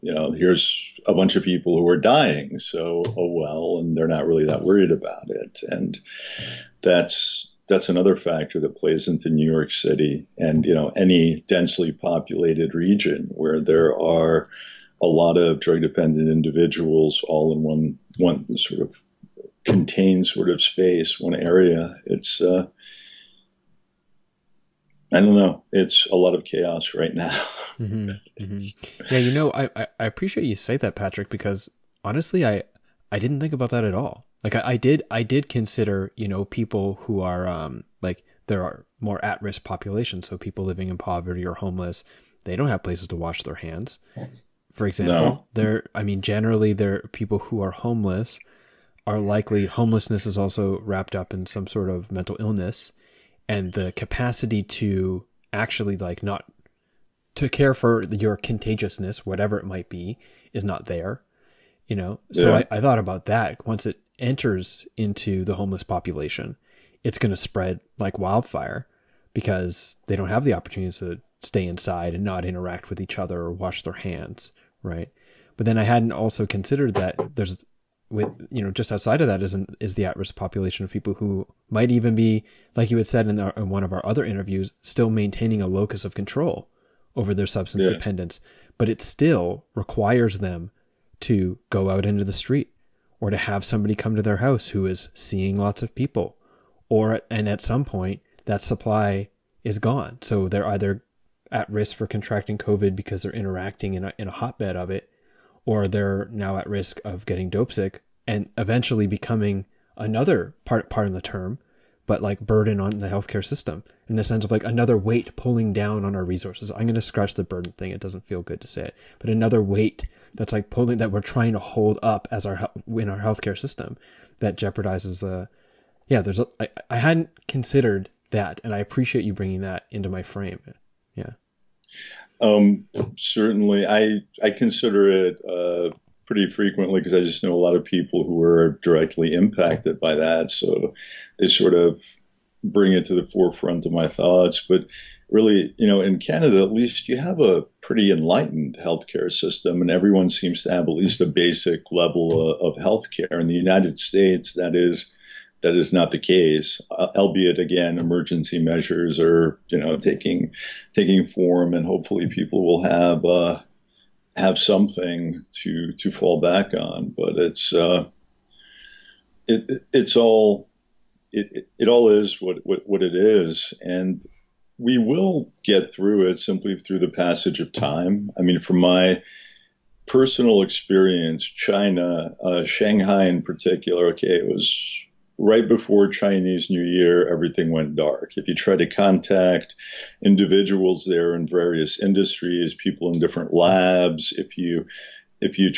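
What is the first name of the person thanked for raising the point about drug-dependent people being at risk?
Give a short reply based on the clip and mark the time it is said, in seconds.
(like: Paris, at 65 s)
Patrick, at 30 s.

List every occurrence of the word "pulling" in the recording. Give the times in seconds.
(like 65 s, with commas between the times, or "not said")
115 s, 120 s.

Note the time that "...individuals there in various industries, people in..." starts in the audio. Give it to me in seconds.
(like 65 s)
190 s.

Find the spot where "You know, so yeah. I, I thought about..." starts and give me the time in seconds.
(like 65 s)
61 s.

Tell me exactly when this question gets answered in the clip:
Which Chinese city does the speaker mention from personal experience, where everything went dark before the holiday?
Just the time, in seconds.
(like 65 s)
182 s.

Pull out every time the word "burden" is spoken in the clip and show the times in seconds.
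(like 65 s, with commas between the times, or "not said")
112 s, 117 s.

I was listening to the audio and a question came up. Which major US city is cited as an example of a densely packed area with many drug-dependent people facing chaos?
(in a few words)
New York City.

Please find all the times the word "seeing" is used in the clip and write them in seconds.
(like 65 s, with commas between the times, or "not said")
95 s.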